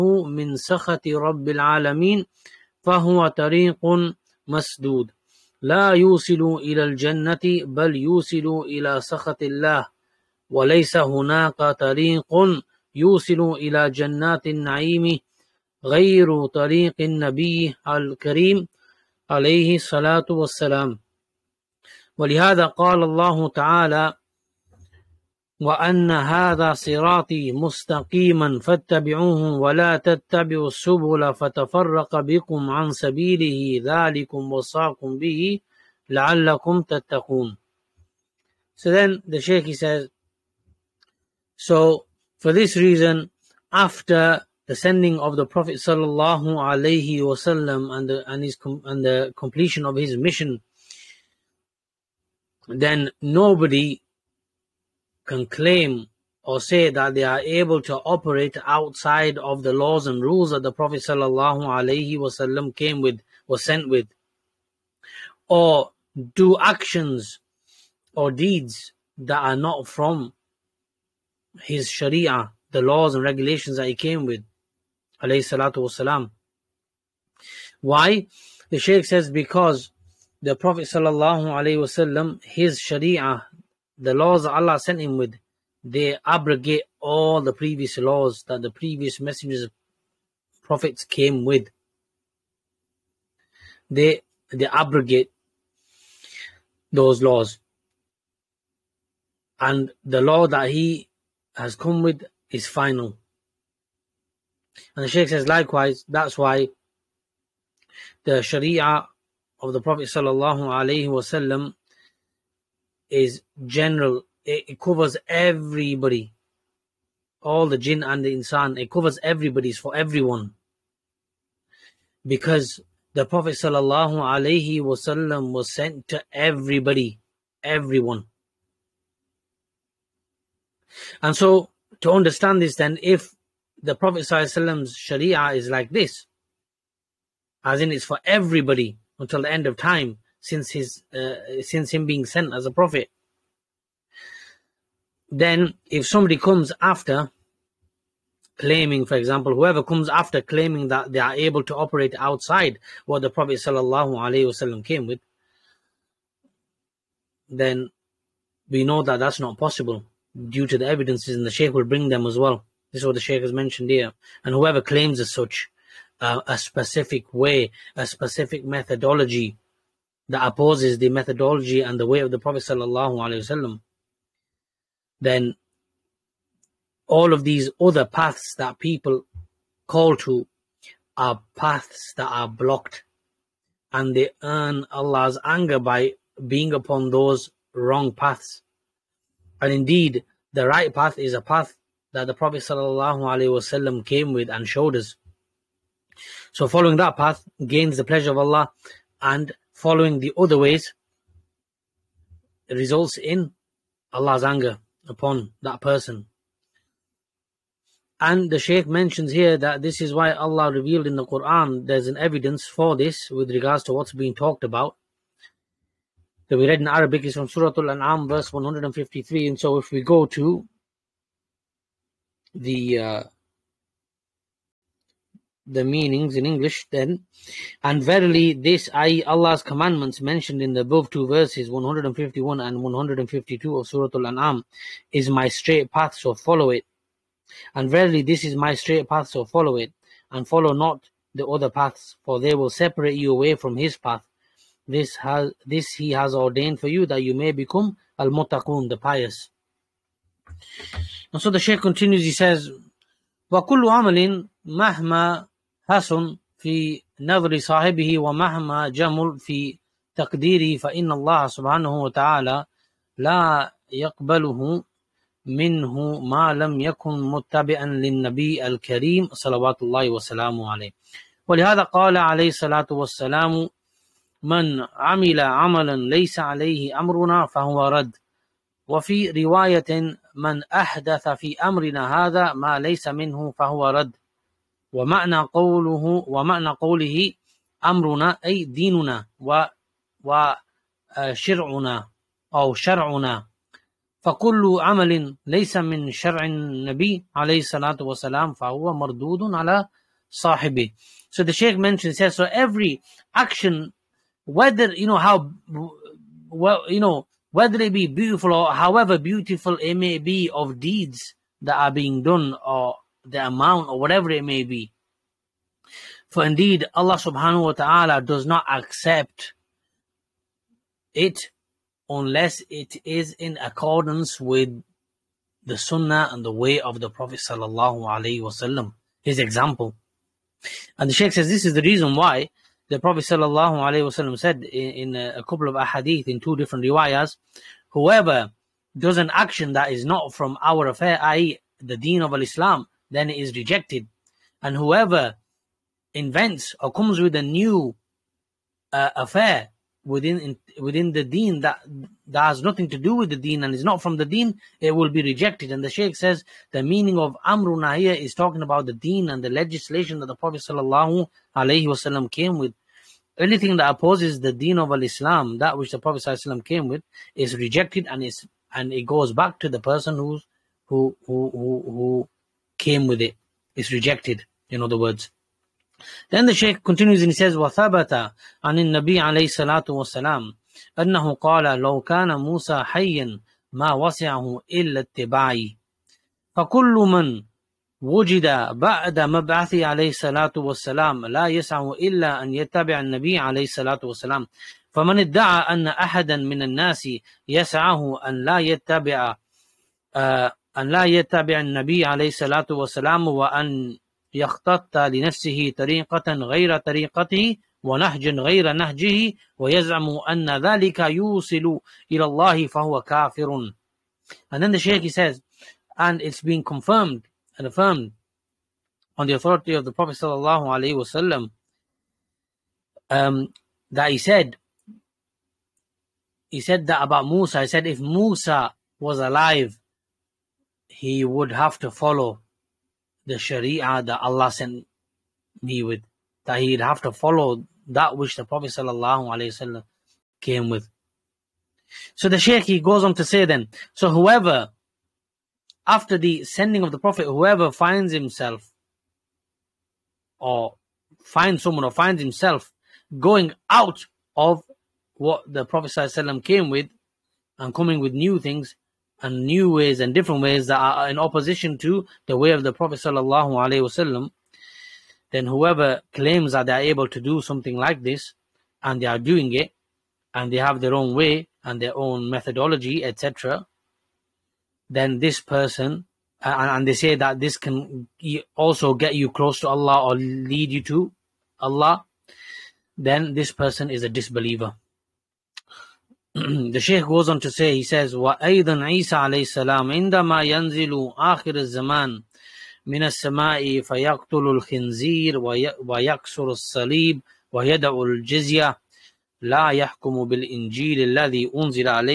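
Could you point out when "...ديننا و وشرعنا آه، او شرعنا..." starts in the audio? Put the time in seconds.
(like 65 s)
288 s.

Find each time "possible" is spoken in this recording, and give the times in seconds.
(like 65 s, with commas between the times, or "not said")
159 s.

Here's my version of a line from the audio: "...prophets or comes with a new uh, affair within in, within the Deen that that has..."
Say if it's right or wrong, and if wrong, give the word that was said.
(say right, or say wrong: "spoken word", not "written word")
wrong: "invents", not "prophets".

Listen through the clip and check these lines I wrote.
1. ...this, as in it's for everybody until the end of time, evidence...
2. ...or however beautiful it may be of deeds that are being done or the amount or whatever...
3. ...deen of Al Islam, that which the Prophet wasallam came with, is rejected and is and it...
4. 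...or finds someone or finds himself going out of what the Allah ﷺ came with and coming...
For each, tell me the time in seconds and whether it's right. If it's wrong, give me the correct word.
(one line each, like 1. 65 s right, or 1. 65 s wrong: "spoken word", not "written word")
1. 135 s wrong: "since", not "evidence"
2. 308 s right
3. 364 s right
4. 450 s wrong: "Prophet", not "Allah".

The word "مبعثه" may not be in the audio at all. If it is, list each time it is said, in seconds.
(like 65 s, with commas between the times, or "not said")
389 s.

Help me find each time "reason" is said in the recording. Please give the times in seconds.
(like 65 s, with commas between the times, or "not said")
42 s, 331 s.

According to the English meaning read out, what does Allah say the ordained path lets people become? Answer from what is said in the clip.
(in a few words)
al muttaqun.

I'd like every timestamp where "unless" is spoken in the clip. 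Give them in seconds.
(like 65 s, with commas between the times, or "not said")
322 s.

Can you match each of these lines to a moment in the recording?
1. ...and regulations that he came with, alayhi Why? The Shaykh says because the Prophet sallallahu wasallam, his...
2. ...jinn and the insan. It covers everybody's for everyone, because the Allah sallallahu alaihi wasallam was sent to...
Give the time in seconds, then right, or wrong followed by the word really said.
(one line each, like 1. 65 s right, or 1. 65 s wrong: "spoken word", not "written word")
1. 73 s right
2. 117 s wrong: "Prophet", not "Allah".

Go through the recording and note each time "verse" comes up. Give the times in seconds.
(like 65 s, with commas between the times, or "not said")
218 s, 231 s.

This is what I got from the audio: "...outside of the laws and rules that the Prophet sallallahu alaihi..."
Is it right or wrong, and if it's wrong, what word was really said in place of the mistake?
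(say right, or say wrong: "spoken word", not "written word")
right.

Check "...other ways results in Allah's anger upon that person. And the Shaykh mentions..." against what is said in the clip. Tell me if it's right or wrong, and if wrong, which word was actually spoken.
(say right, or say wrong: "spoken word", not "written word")
right.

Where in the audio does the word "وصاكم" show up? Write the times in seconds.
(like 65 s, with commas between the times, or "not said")
34 s.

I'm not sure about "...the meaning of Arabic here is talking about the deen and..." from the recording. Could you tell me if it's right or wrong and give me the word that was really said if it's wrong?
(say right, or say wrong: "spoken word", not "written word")
wrong: "Amruna", not "Arabic".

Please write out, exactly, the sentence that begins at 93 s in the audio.
They they abrogate those laws, and the law that he has come with is final.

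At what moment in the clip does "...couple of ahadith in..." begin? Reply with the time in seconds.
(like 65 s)
335 s.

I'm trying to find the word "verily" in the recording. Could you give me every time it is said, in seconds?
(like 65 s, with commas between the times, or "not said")
228 s, 237 s.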